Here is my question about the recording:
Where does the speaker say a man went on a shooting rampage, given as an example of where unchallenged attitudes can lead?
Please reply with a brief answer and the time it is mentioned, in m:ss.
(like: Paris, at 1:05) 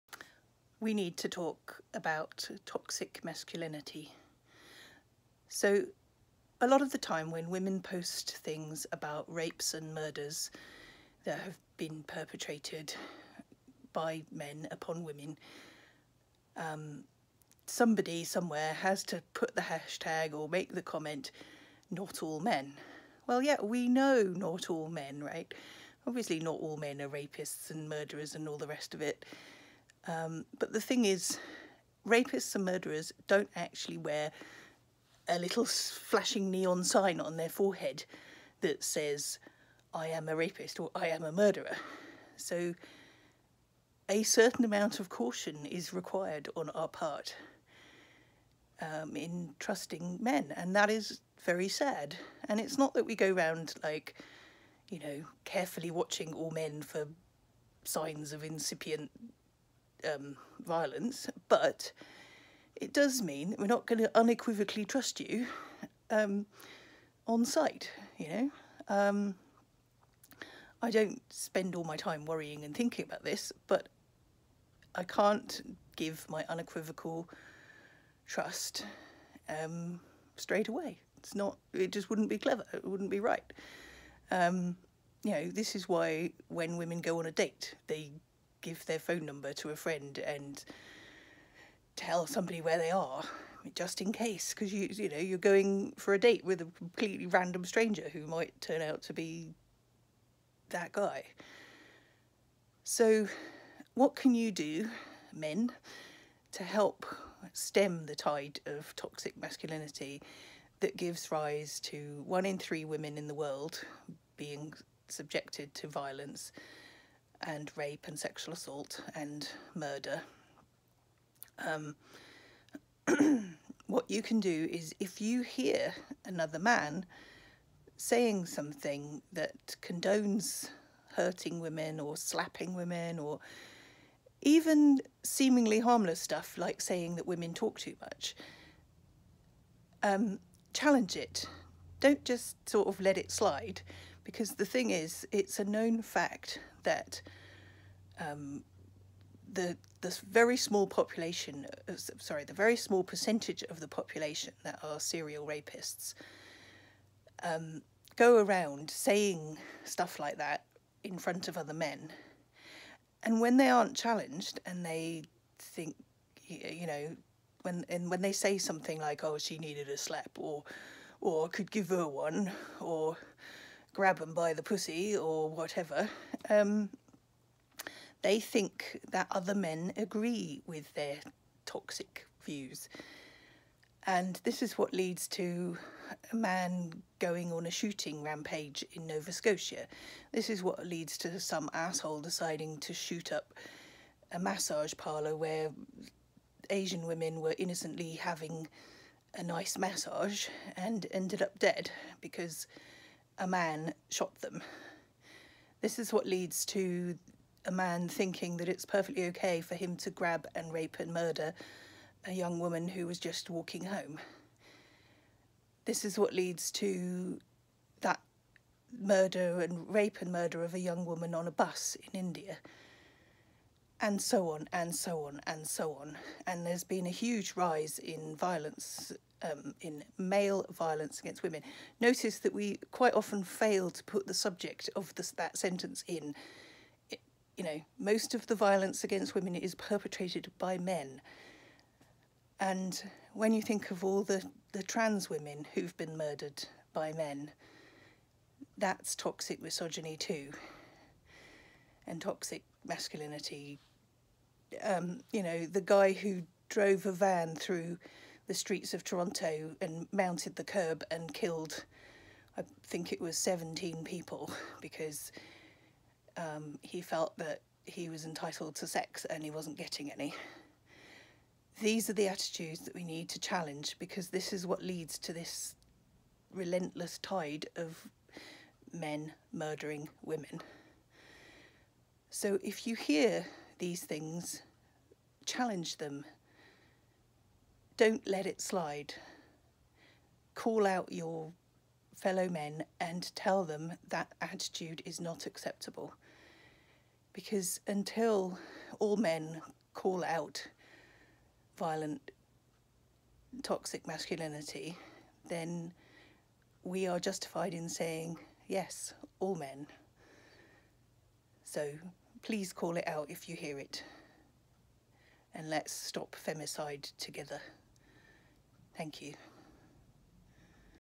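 Nova Scotia, at 3:09.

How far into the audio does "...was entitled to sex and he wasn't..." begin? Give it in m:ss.
4:28.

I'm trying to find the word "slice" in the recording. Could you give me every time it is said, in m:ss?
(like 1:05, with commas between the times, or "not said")
not said.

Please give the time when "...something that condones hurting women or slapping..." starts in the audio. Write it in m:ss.
2:08.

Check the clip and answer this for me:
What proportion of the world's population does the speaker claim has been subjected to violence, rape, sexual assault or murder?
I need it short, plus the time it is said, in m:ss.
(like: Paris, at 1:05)
1 in 3, at 1:52.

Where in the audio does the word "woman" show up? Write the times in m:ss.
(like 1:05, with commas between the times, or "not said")
3:32, 3:41.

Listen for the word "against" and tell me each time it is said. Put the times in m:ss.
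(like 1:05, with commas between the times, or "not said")
3:51, 3:59.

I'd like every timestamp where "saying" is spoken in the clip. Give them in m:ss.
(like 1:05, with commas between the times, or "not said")
2:07, 2:16, 2:38, 5:07.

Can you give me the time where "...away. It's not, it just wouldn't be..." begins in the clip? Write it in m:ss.
1:20.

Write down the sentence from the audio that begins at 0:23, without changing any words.
Well, yeah, we know not all men, right?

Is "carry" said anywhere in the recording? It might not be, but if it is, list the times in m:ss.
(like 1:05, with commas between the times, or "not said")
not said.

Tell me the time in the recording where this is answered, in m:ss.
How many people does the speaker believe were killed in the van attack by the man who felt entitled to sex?
4:23.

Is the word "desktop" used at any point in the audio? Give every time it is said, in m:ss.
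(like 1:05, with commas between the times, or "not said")
not said.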